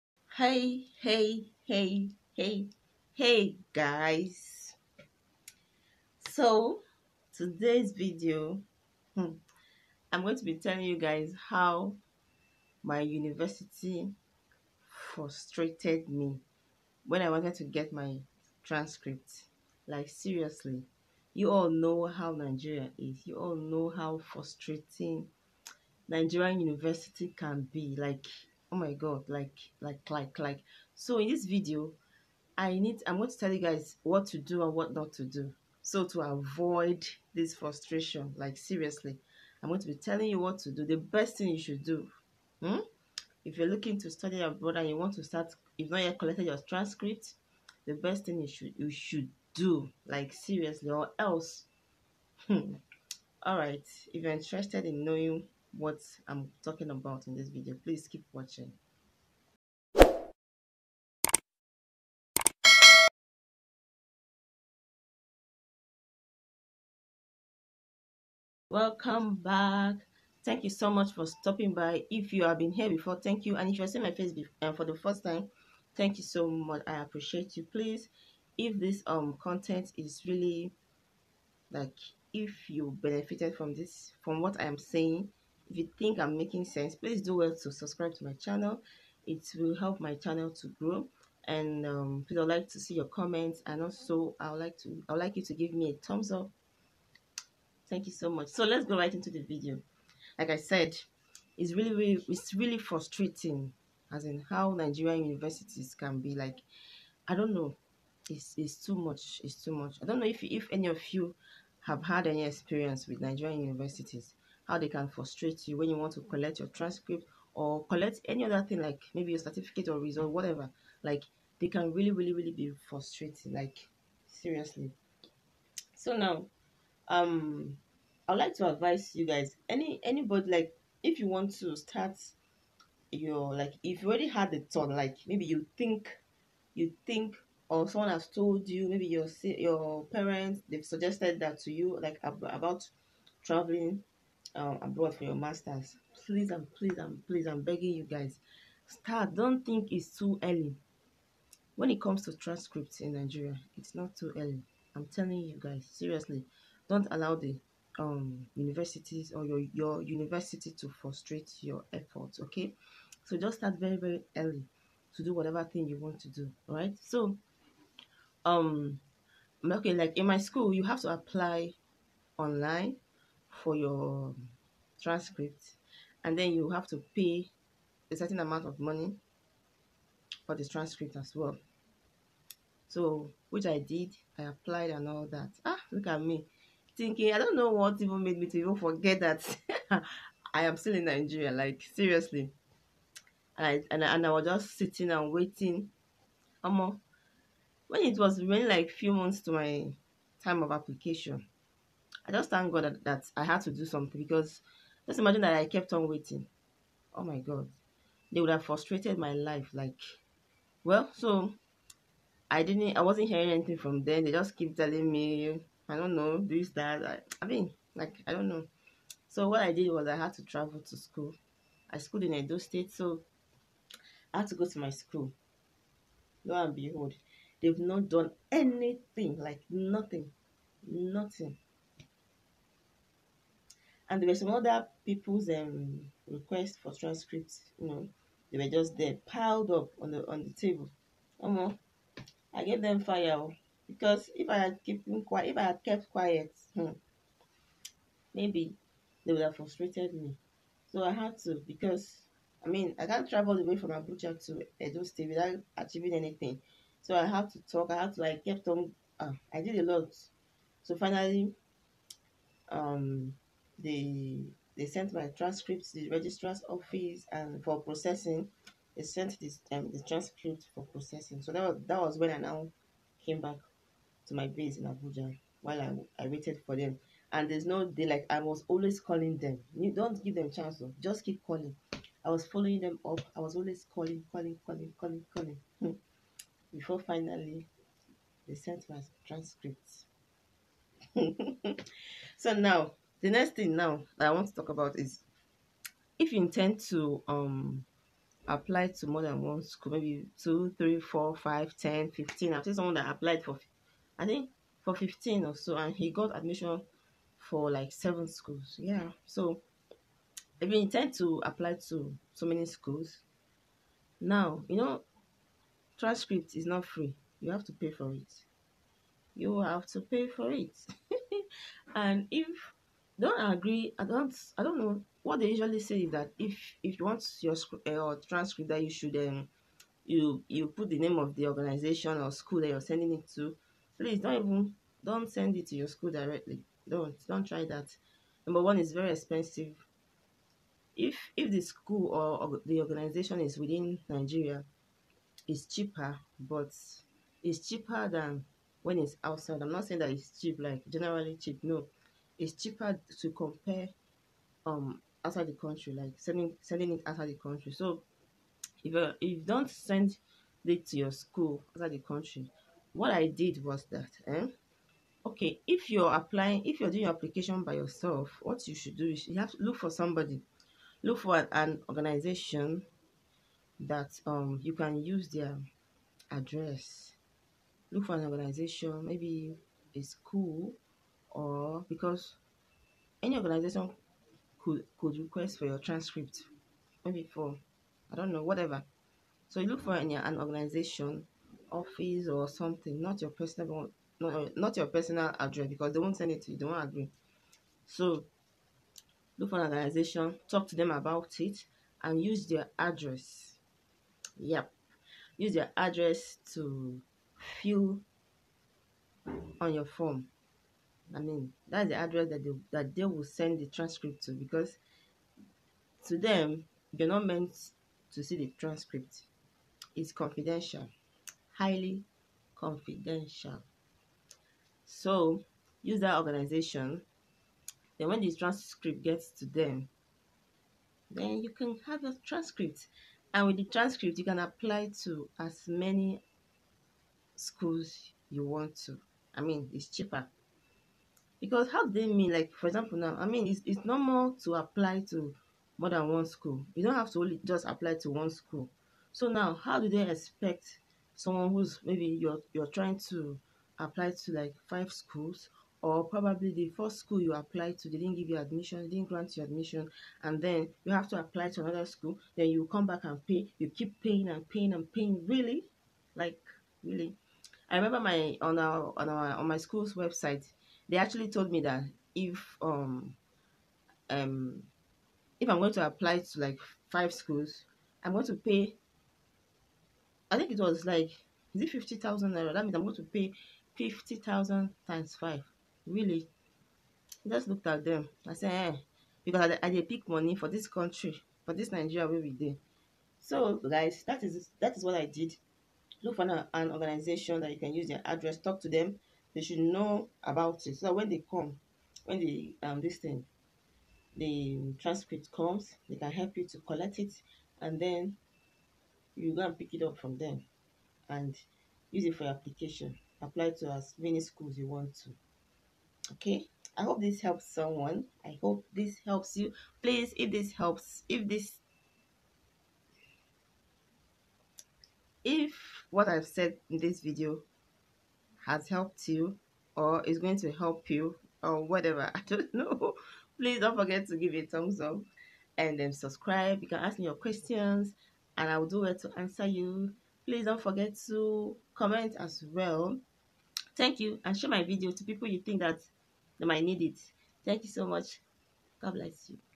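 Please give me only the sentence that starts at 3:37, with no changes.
I, I mean, like, I don't know.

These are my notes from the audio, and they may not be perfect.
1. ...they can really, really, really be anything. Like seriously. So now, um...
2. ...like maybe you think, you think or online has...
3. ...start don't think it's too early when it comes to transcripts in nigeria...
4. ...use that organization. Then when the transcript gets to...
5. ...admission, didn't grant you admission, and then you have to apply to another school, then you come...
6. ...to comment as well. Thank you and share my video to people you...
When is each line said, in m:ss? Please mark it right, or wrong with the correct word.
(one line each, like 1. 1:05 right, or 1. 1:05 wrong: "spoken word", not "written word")
1. 2:01 wrong: "frustrating", not "anything"
2. 2:14 wrong: "someone", not "online"
3. 2:28 right
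4. 7:05 right
5. 7:38 right
6. 9:01 right.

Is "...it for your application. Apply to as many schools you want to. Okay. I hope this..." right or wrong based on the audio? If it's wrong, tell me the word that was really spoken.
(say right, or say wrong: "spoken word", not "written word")
right.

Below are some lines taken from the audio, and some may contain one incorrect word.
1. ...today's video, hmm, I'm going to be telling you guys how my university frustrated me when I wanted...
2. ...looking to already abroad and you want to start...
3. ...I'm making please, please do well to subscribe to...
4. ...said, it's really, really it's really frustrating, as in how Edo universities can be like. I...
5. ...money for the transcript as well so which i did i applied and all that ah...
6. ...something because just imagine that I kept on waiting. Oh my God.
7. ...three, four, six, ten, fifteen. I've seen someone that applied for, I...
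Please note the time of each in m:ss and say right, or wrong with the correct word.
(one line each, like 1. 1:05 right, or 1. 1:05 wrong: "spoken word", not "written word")
1. 0:07 right
2. 0:43 wrong: "study", not "already"
3. 1:26 wrong: "sense", not "please"
4. 1:40 wrong: "Nigerian", not "Edo"
5. 2:58 right
6. 3:23 right
7. 5:00 wrong: "five", not "six".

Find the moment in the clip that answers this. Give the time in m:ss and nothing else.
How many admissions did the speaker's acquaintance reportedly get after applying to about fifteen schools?
5:07.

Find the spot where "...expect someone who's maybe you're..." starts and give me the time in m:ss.
7:30.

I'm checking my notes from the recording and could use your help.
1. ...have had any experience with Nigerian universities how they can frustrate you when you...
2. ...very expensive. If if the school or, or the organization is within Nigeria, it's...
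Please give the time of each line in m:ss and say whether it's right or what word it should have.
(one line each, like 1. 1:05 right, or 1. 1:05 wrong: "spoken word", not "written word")
1. 1:51 right
2. 5:38 right.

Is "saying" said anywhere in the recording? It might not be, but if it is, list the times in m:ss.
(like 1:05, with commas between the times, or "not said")
1:24, 5:49.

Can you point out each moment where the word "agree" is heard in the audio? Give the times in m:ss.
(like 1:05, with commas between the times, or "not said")
5:23, 6:36.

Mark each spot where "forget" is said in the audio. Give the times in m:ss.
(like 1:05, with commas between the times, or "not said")
3:08, 8:53, 9:00.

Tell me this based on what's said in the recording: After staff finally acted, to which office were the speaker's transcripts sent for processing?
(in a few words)
Registrar's office.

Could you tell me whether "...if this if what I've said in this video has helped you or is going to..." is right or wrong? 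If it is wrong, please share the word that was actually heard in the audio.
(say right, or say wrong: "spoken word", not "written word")
right.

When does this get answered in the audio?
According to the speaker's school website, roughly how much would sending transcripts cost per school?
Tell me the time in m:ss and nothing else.
8:01.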